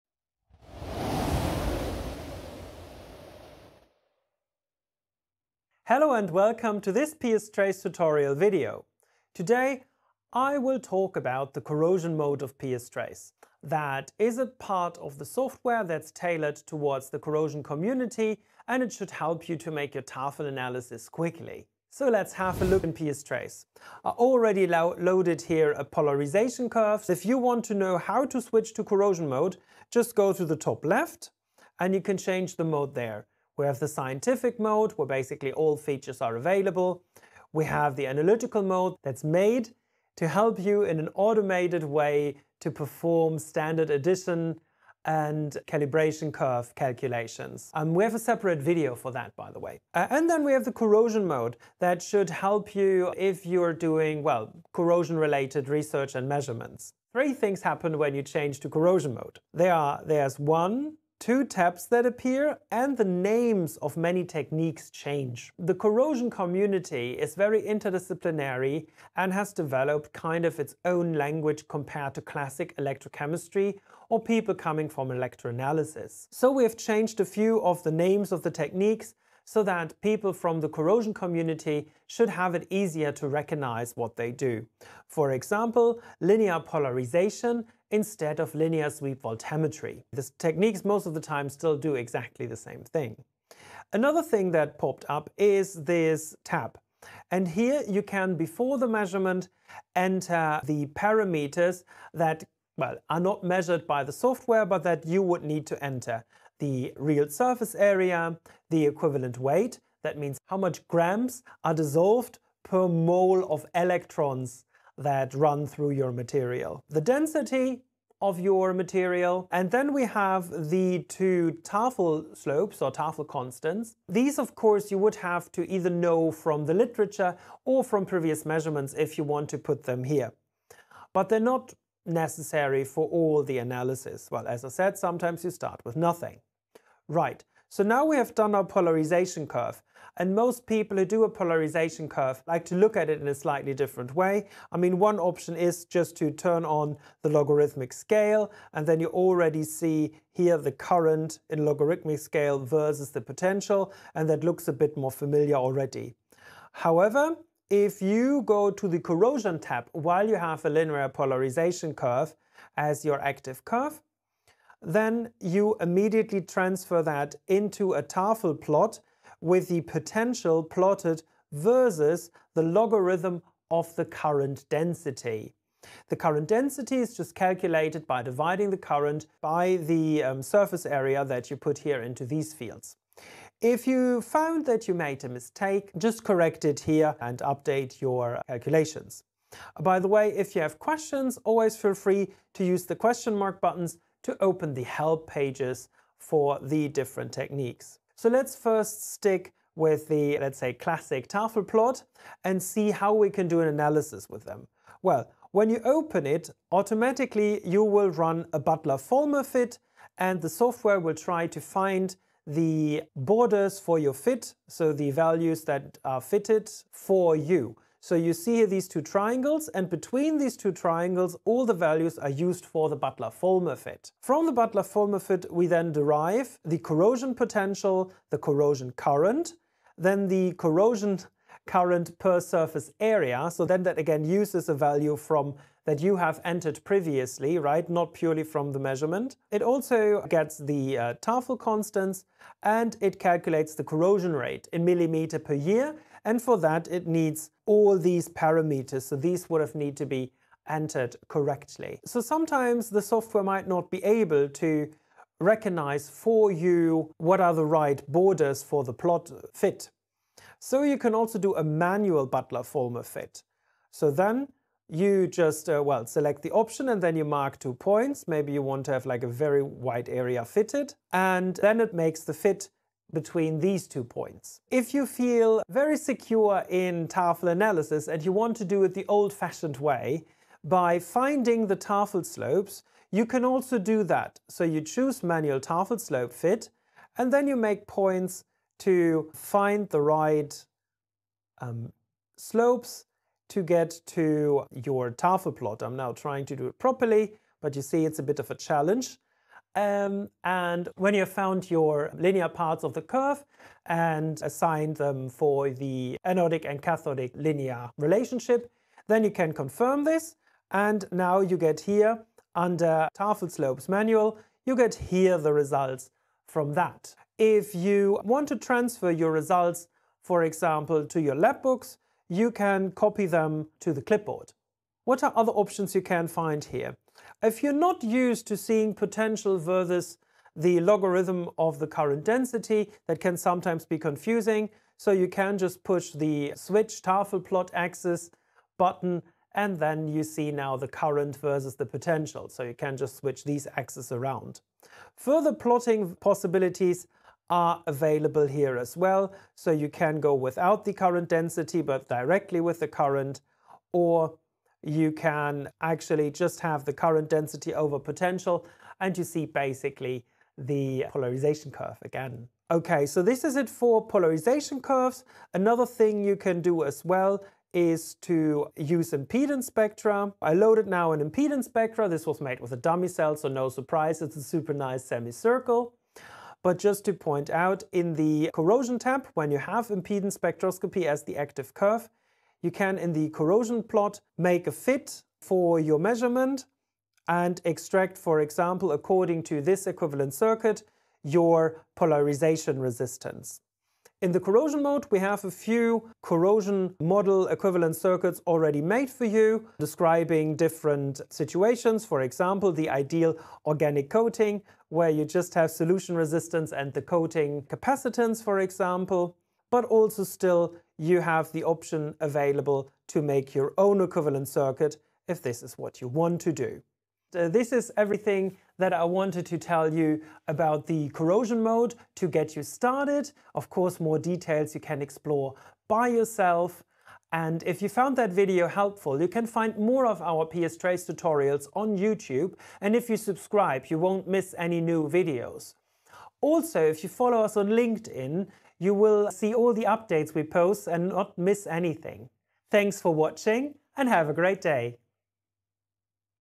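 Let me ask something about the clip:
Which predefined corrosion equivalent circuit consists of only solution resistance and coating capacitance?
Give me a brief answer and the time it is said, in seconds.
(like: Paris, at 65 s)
Ideal organic coating, at 402 s.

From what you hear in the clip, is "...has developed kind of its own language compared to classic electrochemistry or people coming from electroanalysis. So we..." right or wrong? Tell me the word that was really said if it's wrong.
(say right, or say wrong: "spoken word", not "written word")
right.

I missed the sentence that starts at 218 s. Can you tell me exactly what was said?
So you see here these two triangles, and between these two triangles, all the values are used for the Butler-Volmer fit.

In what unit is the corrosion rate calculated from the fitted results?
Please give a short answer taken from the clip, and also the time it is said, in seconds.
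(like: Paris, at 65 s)
Millimeter per year, at 244 s.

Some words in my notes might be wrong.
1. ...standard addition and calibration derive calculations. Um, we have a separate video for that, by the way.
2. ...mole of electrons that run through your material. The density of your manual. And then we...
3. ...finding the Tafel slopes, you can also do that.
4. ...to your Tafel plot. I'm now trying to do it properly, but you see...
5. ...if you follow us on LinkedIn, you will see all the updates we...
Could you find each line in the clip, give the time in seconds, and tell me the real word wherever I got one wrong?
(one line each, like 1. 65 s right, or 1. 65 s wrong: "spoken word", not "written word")
1. 43 s wrong: "curve", not "derive"
2. 112 s wrong: "material", not "manual"
3. 280 s right
4. 294 s right
5. 436 s right.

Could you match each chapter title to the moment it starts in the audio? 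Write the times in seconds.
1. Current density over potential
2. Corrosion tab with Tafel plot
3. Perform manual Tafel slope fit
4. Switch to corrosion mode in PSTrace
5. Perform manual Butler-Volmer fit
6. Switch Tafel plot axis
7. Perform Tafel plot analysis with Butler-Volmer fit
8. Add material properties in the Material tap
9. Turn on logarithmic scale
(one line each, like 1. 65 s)
1. 358 s
2. 157 s
3. 274 s
4. 27 s
5. 253 s
6. 328 s
7. 197 s
8. 91 s
9. 137 s.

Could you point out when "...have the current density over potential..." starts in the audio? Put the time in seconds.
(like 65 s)
356 s.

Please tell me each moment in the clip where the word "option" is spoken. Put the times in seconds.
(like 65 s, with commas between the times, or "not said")
145 s, 266 s, 325 s, 411 s.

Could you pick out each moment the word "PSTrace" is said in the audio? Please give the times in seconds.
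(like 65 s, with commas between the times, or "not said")
7 s, 12 s, 22 s, 430 s.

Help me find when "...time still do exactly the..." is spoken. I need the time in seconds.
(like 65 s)
91 s.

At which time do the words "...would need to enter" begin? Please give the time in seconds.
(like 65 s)
105 s.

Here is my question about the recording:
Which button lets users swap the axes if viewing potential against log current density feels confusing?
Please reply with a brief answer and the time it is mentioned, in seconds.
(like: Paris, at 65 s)
Switch Tafel plot axis, at 336 s.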